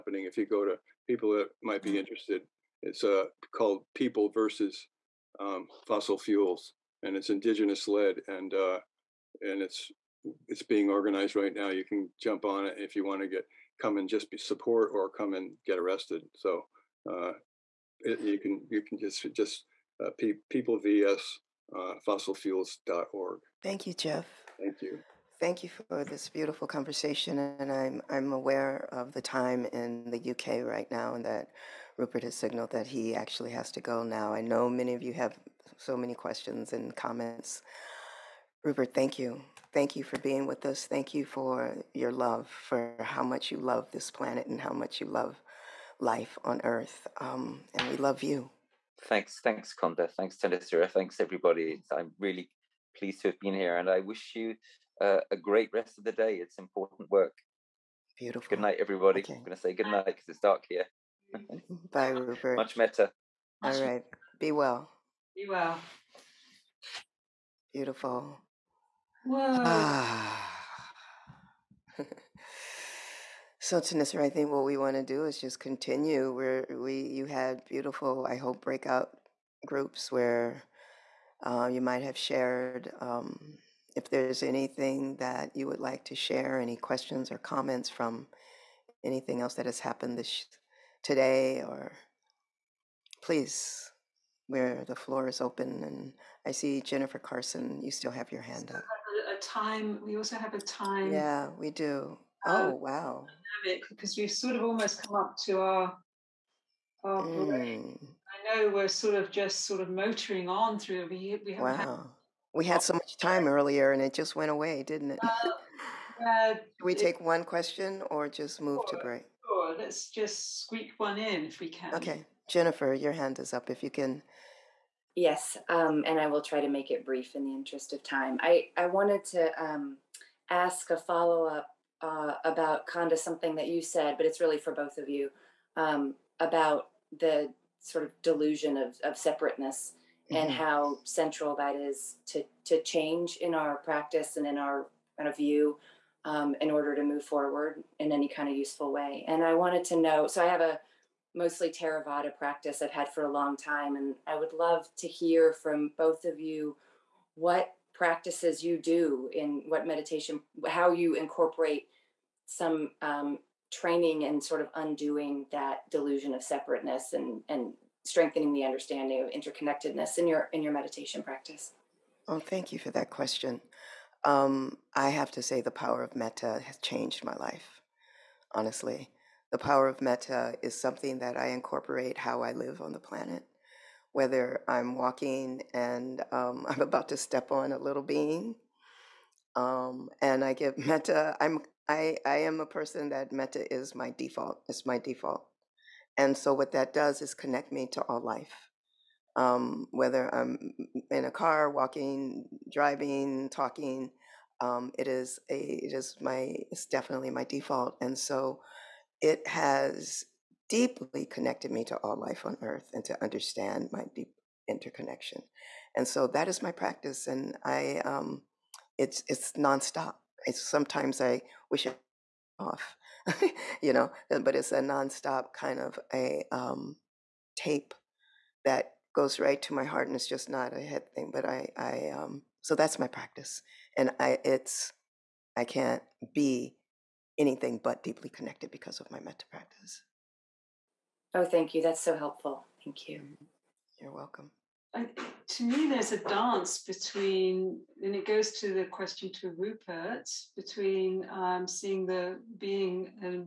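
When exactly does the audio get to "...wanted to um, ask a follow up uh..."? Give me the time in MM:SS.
02:08.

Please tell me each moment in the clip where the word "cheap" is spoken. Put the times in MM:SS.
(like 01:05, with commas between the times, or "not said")
not said.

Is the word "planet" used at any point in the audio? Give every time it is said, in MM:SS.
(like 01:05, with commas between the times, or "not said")
00:44, 03:02.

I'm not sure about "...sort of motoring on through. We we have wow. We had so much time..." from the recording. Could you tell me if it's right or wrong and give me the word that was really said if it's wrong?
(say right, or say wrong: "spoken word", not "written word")
right.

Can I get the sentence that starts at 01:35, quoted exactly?
And I see Jennifer Carson, you still have your hand up.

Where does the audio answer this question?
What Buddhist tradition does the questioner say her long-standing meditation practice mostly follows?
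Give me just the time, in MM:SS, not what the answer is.
02:31.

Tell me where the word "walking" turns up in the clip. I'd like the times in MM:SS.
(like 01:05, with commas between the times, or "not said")
03:04, 03:21.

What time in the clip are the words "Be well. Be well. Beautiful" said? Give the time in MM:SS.
01:04.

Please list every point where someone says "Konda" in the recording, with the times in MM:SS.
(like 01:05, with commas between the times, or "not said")
00:49, 02:12.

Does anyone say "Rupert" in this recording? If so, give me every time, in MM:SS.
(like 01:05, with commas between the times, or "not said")
00:31, 00:38, 01:02, 04:09.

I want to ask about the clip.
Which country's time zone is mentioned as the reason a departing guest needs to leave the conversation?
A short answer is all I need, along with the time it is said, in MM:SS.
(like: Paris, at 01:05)
UK, at 00:30.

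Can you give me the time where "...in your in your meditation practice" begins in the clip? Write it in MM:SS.
02:50.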